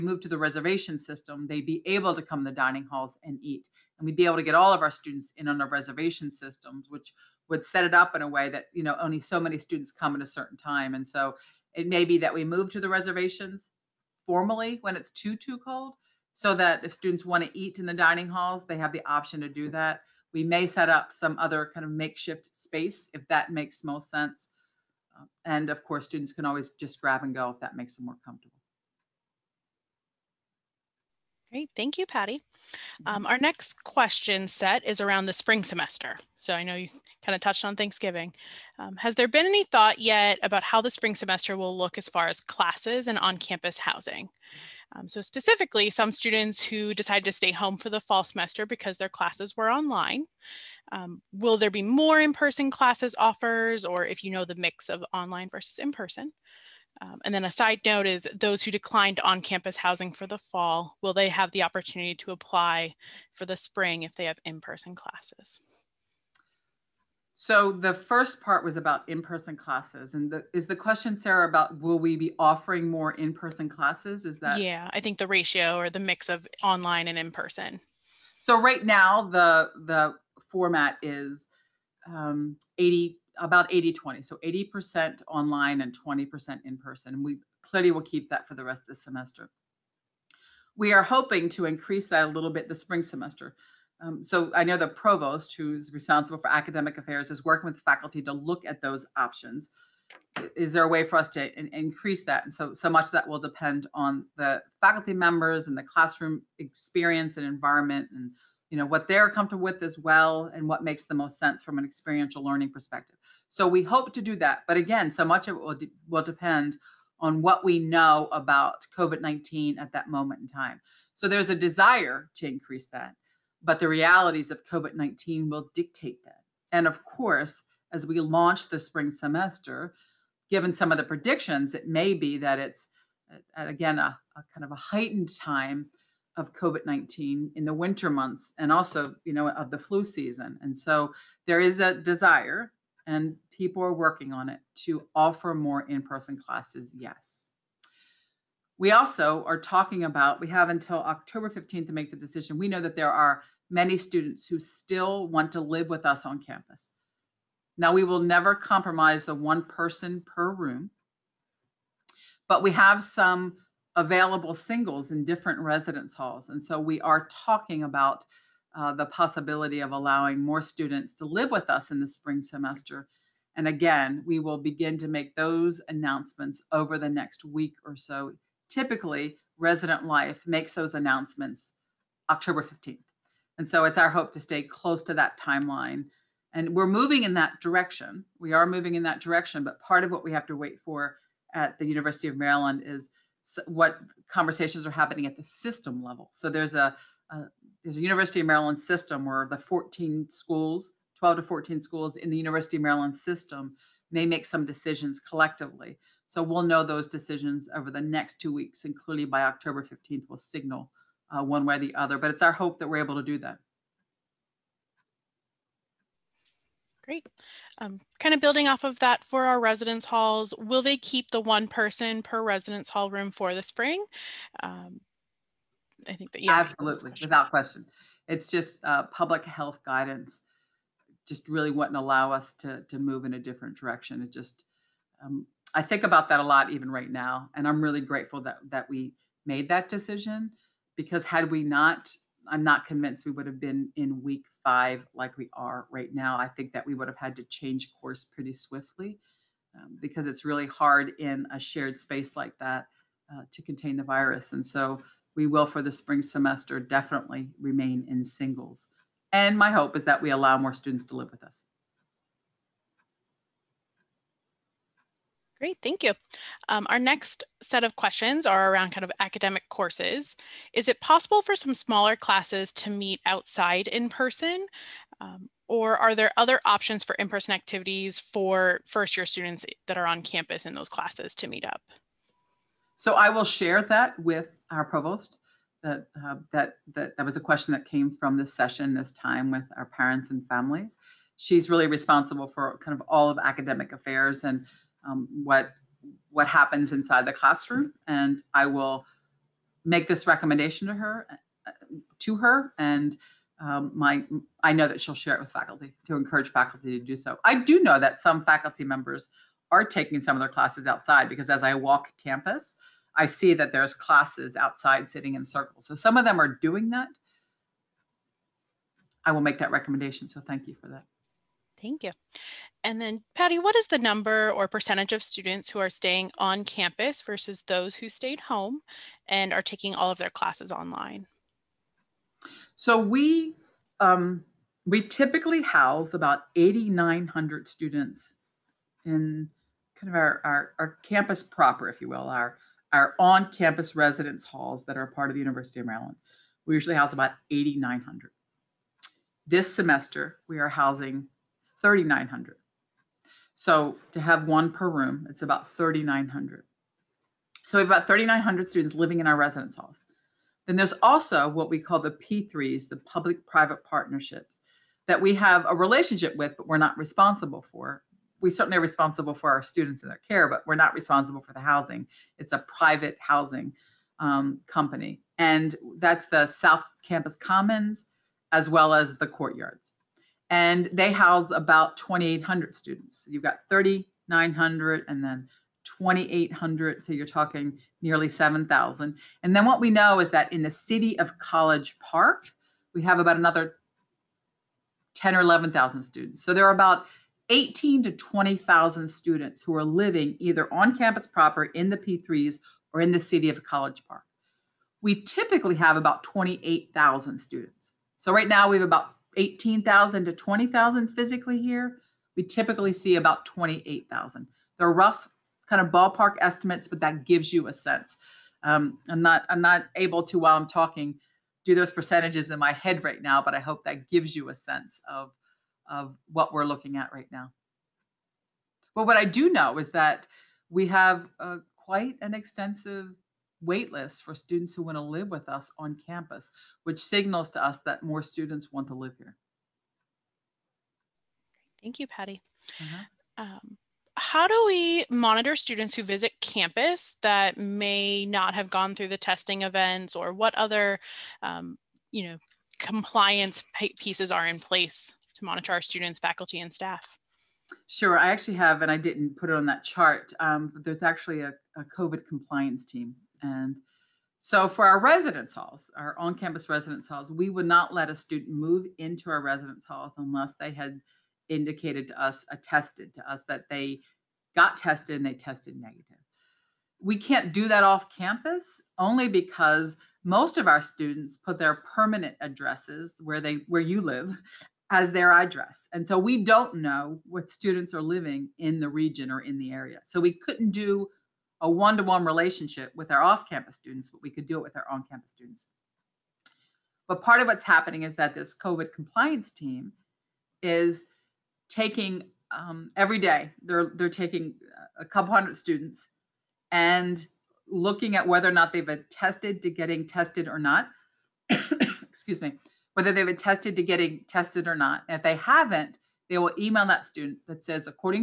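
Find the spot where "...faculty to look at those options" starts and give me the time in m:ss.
1:37.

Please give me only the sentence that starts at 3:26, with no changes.
So we'll know those decisions over the next two weeks, including by October 15th, we'll signal uh, one way or the other.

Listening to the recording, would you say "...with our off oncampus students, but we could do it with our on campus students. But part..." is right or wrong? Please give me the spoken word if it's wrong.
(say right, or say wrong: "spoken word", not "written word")
wrong: "campus", not "oncampus".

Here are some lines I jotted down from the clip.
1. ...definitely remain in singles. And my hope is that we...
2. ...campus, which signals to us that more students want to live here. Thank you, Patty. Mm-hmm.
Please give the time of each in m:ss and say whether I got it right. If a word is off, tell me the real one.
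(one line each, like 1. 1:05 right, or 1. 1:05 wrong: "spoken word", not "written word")
1. 4:16 right
2. 7:16 right.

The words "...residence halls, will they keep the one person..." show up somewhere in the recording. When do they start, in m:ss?
3:39.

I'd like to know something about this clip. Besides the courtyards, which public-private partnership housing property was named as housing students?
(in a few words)
South Campus Commons.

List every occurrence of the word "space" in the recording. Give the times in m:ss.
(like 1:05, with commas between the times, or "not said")
0:22, 4:11.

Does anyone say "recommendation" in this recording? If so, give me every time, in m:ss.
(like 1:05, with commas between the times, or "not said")
5:00, 5:19.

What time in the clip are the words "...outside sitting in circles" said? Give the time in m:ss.
5:14.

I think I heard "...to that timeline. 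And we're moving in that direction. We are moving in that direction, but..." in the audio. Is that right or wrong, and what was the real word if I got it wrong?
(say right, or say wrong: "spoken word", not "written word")
right.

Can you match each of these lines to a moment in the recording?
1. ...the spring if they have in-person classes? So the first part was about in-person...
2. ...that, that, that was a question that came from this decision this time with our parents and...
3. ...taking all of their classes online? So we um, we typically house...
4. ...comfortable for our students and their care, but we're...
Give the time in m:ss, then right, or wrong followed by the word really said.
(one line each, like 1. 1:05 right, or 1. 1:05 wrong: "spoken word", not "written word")
1. 1:03 right
2. 4:46 wrong: "session", not "decision"
3. 5:29 right
4. 6:08 wrong: "responsible", not "comfortable".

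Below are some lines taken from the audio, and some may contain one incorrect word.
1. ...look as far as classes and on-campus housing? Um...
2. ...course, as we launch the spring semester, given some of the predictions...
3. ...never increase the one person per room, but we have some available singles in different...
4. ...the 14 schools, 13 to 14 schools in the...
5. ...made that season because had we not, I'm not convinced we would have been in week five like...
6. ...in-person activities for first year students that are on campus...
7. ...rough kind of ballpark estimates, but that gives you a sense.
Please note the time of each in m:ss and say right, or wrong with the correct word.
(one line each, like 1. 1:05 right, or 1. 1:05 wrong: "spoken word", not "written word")
1. 0:41 right
2. 2:07 right
3. 2:38 wrong: "compromise", not "increase"
4. 3:19 wrong: "12", not "13"
5. 3:59 wrong: "decision", not "season"
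6. 4:37 right
7. 6:54 right.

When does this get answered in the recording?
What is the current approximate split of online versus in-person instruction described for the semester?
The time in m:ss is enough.
1:23.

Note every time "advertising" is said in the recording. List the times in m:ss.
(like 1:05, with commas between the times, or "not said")
not said.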